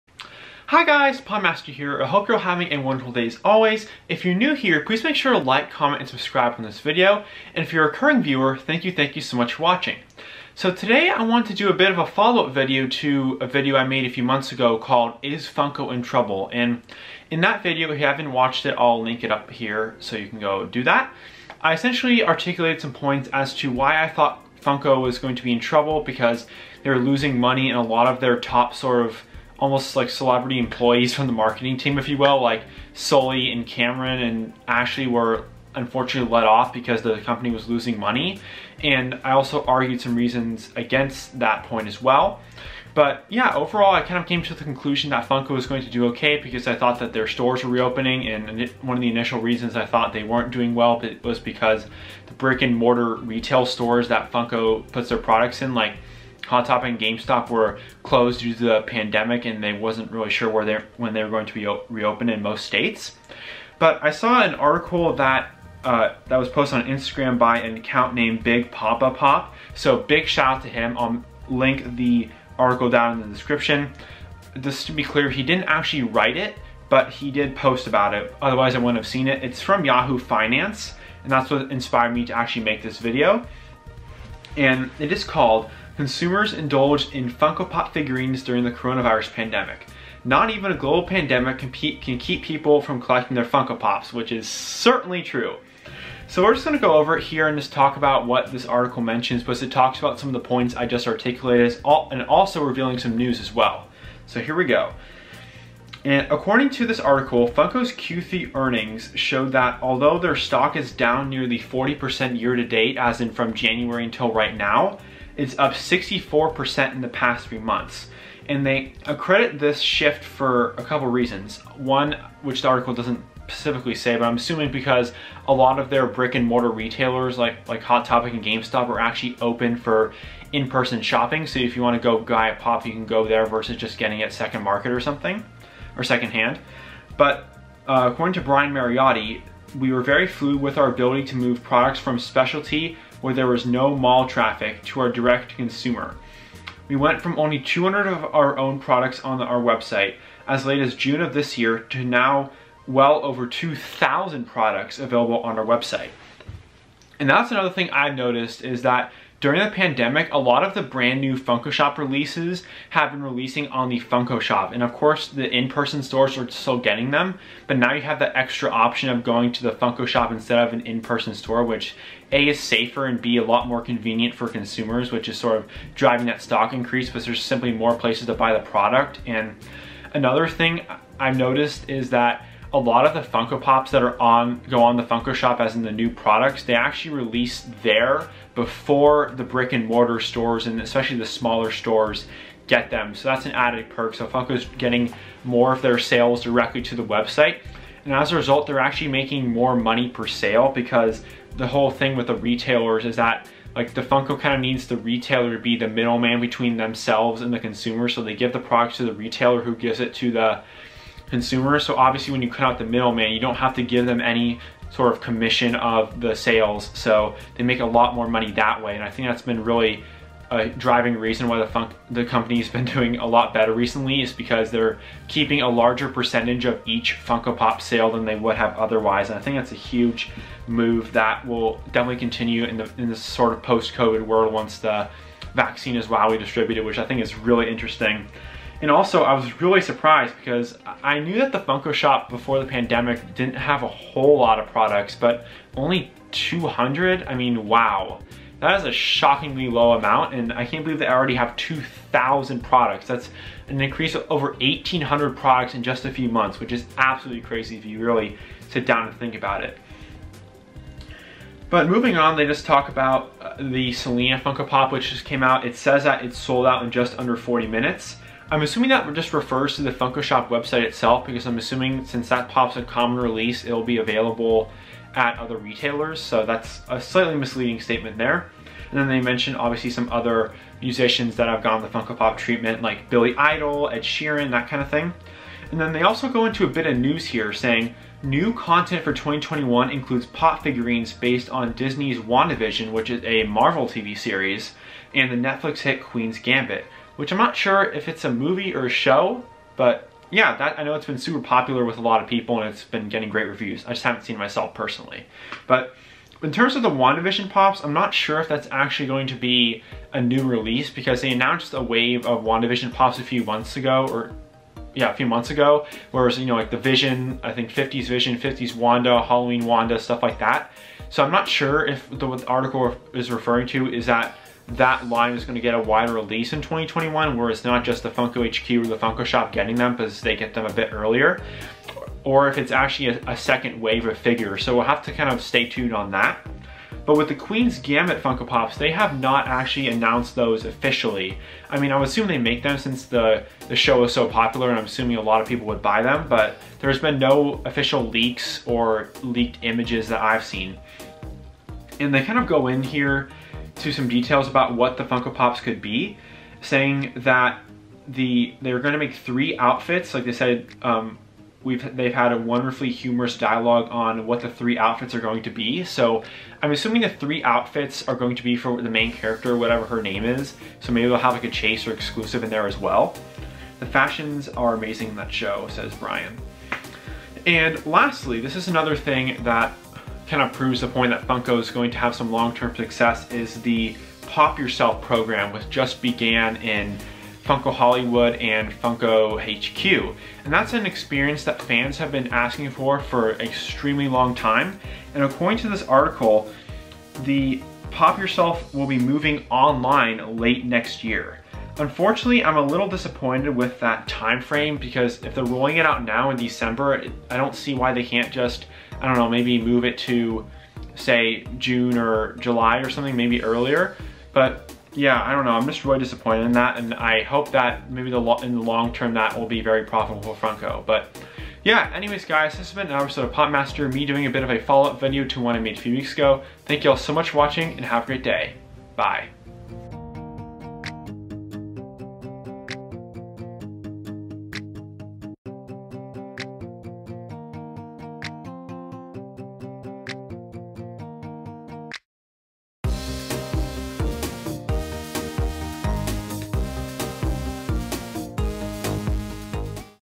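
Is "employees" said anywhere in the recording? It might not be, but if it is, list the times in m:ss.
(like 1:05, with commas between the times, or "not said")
0:30.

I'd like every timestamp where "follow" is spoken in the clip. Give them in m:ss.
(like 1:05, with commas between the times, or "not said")
0:12, 7:04.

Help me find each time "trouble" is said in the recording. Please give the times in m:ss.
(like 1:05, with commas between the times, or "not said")
0:16, 0:25.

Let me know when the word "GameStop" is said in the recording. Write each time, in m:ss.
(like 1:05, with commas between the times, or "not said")
0:56, 2:08.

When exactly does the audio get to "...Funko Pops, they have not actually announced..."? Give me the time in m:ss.
5:38.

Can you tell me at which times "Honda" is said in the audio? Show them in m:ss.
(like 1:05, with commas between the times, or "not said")
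not said.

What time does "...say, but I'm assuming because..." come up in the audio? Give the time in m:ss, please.
2:03.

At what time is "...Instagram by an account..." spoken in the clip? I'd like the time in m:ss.
1:06.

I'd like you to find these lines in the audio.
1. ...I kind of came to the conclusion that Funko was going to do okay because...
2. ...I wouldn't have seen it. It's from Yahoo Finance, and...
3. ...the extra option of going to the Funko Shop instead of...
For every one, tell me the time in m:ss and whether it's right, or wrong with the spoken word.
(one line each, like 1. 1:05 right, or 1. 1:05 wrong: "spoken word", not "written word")
1. 0:43 right
2. 1:18 right
3. 2:48 right.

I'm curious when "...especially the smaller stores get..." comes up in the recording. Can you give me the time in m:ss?
3:10.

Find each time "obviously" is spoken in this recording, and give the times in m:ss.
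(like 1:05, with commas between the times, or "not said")
3:31, 4:39.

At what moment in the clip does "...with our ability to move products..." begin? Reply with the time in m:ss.
2:20.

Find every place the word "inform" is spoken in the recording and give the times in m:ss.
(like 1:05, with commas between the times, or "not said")
not said.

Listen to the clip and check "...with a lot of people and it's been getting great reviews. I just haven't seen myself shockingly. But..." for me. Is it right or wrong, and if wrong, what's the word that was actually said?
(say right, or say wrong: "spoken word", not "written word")
wrong: "personally", not "shockingly".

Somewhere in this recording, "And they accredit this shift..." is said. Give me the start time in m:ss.
1:58.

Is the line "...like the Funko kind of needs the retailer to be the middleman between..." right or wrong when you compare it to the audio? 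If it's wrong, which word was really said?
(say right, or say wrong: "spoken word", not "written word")
right.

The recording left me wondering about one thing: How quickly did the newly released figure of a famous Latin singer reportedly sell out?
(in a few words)
under 40 minutes.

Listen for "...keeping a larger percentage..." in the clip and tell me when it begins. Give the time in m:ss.
3:45.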